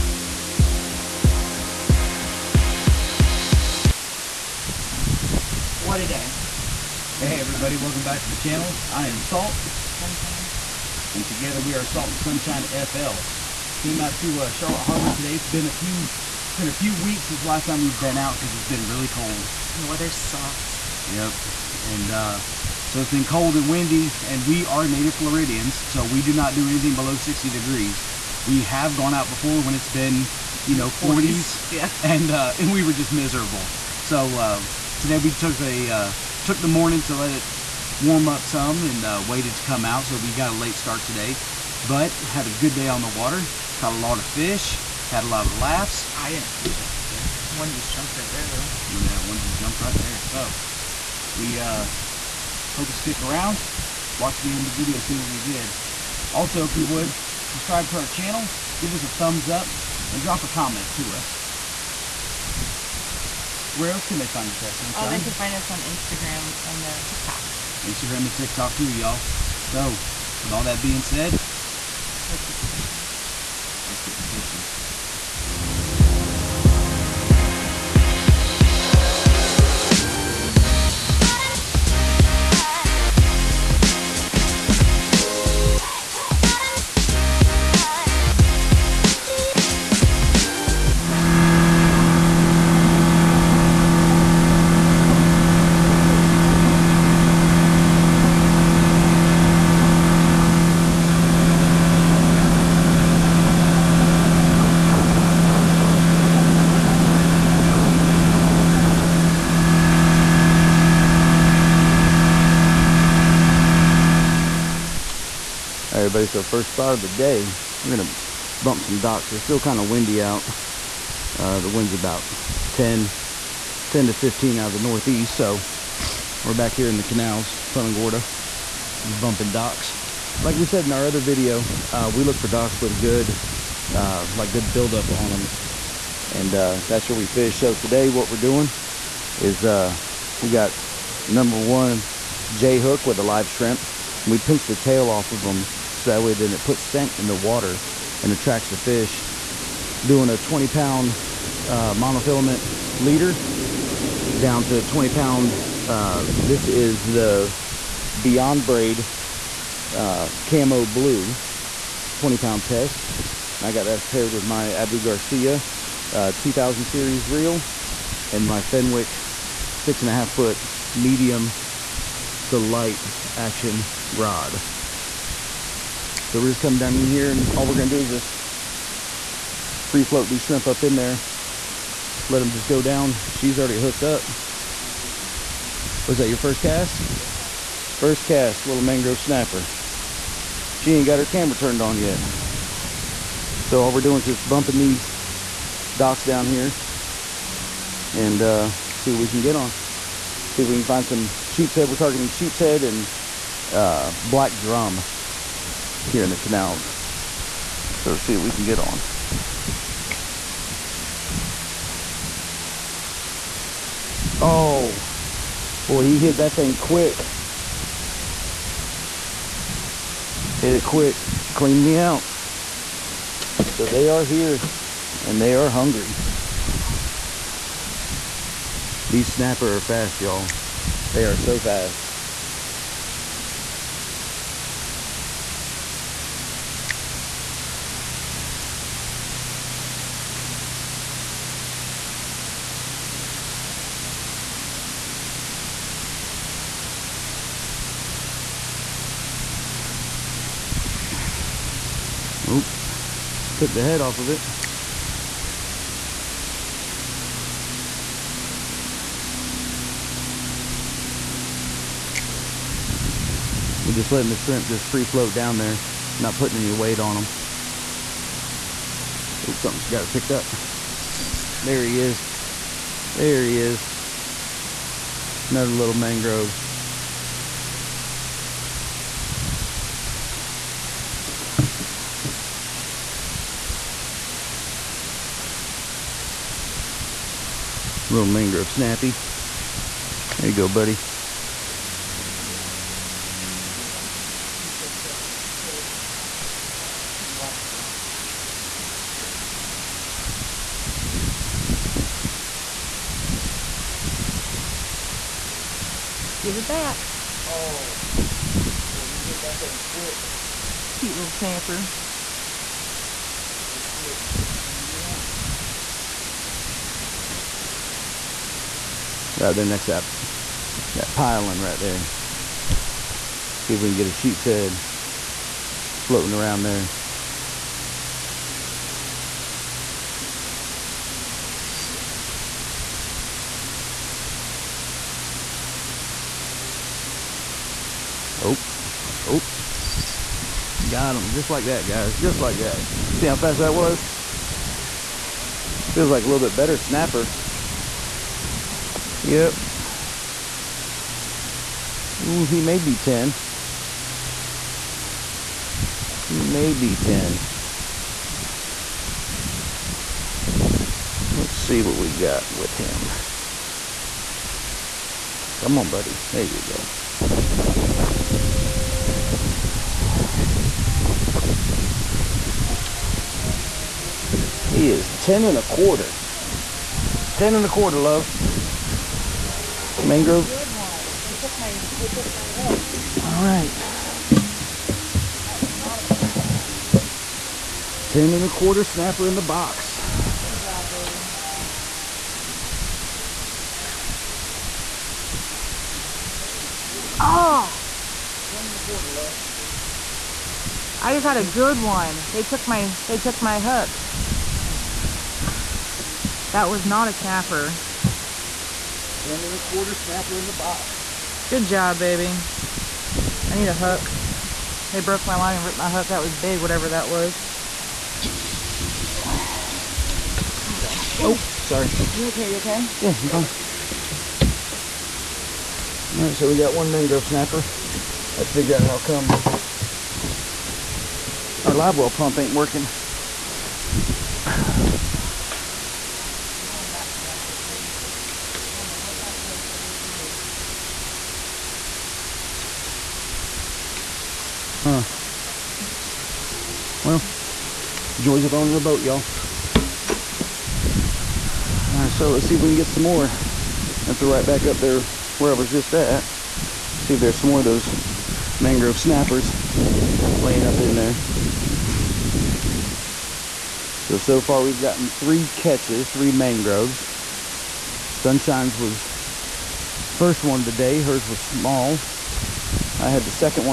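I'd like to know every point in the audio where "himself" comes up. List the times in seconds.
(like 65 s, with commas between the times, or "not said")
not said.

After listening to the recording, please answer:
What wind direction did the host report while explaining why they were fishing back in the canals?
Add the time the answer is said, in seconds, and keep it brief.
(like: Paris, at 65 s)
Northeast, at 124 s.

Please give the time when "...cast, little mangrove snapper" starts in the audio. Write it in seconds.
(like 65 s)
188 s.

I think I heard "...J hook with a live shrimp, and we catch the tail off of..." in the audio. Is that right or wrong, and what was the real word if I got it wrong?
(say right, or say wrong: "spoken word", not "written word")
wrong: "pinch", not "catch".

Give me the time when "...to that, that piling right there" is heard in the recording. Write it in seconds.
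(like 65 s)
319 s.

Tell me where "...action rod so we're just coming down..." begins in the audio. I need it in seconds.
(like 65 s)
173 s.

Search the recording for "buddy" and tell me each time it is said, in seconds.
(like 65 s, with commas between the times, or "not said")
290 s, 365 s.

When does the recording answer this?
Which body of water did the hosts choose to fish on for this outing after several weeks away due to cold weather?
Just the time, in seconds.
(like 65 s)
14 s.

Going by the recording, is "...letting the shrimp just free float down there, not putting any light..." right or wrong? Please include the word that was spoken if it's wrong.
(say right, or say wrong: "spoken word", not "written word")
wrong: "weight", not "light".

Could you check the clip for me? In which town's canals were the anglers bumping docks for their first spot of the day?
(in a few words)
Punta Gorda.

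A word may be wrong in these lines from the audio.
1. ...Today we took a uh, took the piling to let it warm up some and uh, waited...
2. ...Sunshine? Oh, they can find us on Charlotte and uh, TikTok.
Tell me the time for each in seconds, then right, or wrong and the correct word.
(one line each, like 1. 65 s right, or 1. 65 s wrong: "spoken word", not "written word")
1. 35 s wrong: "morning", not "piling"
2. 64 s wrong: "Instagram", not "Charlotte".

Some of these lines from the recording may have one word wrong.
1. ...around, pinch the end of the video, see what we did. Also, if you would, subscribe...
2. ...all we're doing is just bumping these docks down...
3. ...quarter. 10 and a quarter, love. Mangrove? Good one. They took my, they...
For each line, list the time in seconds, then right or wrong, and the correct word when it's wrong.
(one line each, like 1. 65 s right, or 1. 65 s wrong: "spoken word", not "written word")
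1. 53 s wrong: "watch", not "pinch"
2. 193 s right
3. 375 s right.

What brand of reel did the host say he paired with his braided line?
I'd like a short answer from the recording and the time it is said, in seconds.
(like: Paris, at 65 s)
Abu Garcia, at 164 s.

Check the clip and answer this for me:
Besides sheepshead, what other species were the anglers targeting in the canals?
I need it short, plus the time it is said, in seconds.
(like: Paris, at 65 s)
Black drum, at 204 s.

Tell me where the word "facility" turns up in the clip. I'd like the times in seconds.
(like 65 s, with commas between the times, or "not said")
not said.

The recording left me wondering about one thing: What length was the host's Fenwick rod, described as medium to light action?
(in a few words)
6 and a half foot.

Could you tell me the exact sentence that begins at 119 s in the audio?
It's still kind of windy out.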